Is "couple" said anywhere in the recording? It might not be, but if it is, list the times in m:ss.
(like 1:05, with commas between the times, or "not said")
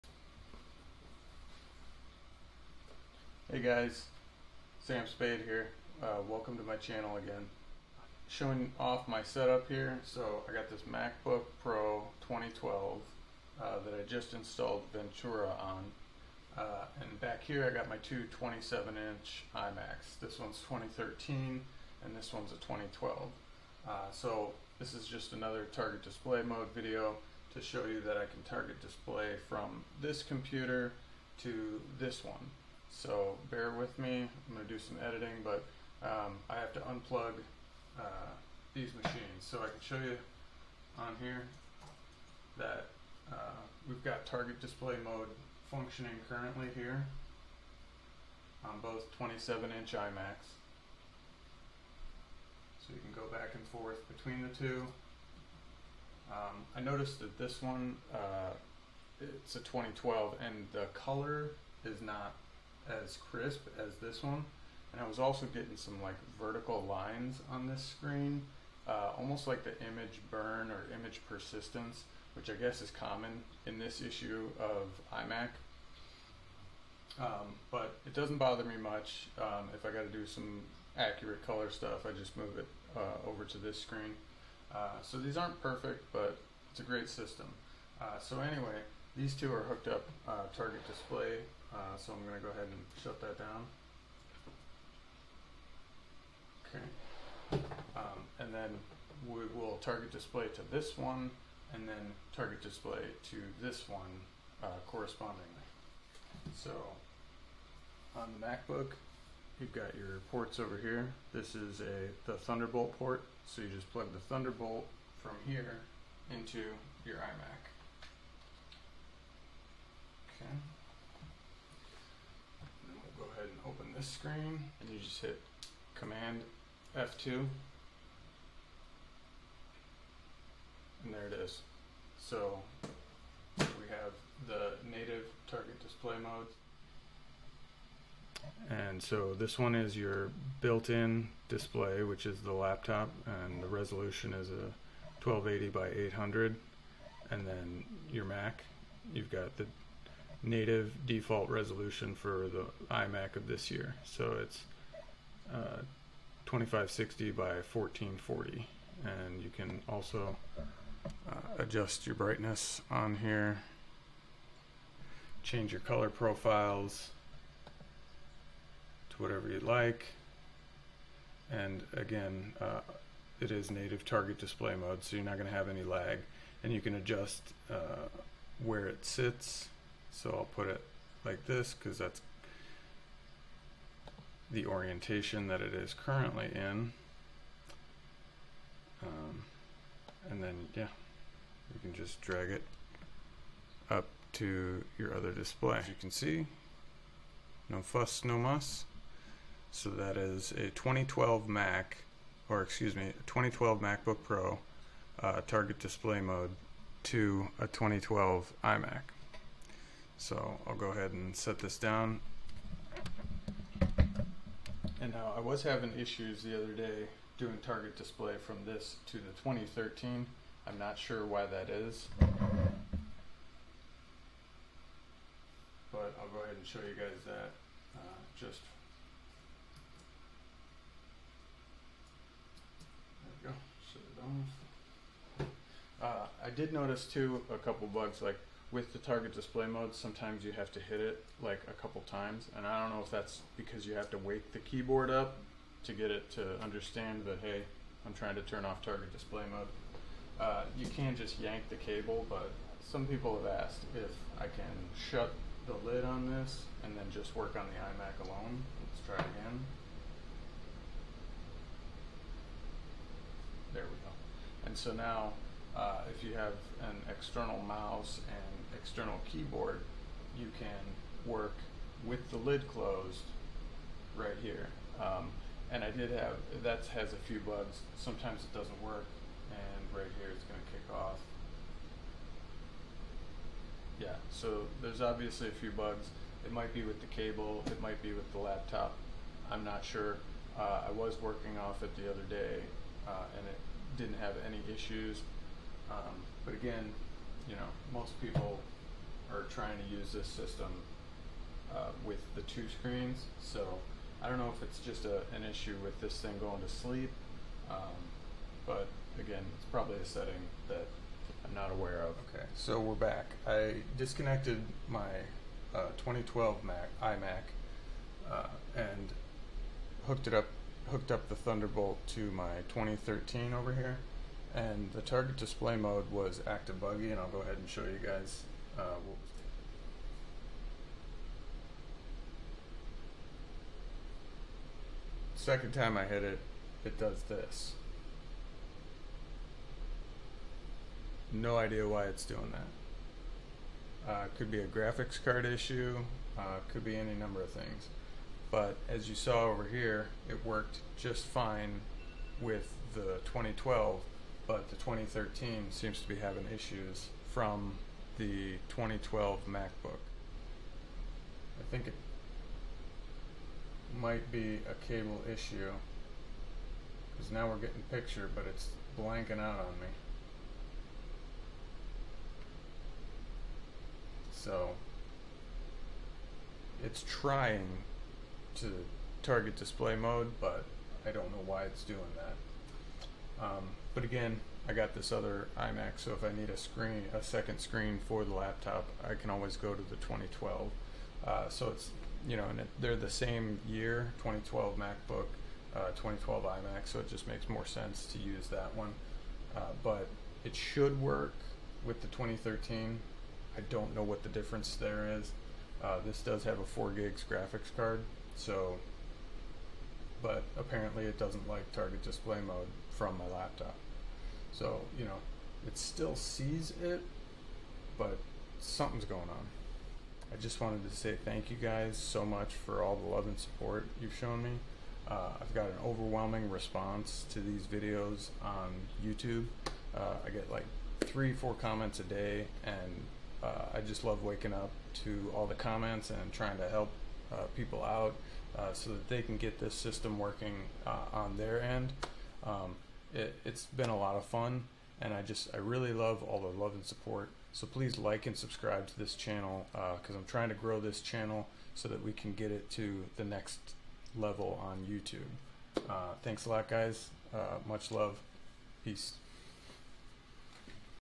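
3:57, 4:01.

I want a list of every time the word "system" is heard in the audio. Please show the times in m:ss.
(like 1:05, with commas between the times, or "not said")
1:27, 5:00, 7:19.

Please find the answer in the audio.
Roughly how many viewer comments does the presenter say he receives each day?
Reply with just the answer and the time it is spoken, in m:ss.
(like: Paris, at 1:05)
3 or 4, at 7:11.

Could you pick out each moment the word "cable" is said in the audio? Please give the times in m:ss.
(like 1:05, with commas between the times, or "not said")
4:11, 4:47, 6:04.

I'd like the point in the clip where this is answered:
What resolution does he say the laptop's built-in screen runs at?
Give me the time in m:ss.
2:25.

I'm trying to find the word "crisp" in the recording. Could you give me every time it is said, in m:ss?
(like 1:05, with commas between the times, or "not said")
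1:03.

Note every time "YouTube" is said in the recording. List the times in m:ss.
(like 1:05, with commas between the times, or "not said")
7:09, 7:34.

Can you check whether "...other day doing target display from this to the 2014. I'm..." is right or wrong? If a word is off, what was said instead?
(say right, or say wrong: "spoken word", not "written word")
wrong: "2013", not "2014".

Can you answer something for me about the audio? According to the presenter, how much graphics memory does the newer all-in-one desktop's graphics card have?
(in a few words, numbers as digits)
4 gigs.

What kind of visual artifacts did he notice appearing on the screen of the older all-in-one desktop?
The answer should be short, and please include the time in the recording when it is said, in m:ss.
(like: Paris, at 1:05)
vertical lines, at 1:06.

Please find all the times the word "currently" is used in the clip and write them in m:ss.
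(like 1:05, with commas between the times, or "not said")
0:46, 3:05.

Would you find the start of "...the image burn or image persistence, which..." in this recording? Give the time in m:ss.
1:09.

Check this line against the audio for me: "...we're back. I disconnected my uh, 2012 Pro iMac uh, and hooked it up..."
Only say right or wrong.
wrong.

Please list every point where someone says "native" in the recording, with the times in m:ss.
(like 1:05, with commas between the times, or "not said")
2:14, 2:30, 2:53.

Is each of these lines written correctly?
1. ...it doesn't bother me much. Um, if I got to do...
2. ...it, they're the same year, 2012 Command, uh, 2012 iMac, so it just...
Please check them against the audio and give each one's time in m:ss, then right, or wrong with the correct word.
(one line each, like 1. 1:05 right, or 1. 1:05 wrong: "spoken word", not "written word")
1. 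1:18 right
2. 6:32 wrong: "MacBook", not "Command".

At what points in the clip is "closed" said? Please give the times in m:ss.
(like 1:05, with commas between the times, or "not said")
4:32.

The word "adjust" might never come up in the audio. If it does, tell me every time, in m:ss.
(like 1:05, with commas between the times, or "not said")
2:41, 2:56.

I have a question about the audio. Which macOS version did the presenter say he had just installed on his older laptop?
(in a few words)
Ventura.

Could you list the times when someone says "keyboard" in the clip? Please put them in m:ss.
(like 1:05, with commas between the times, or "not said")
4:04, 4:29.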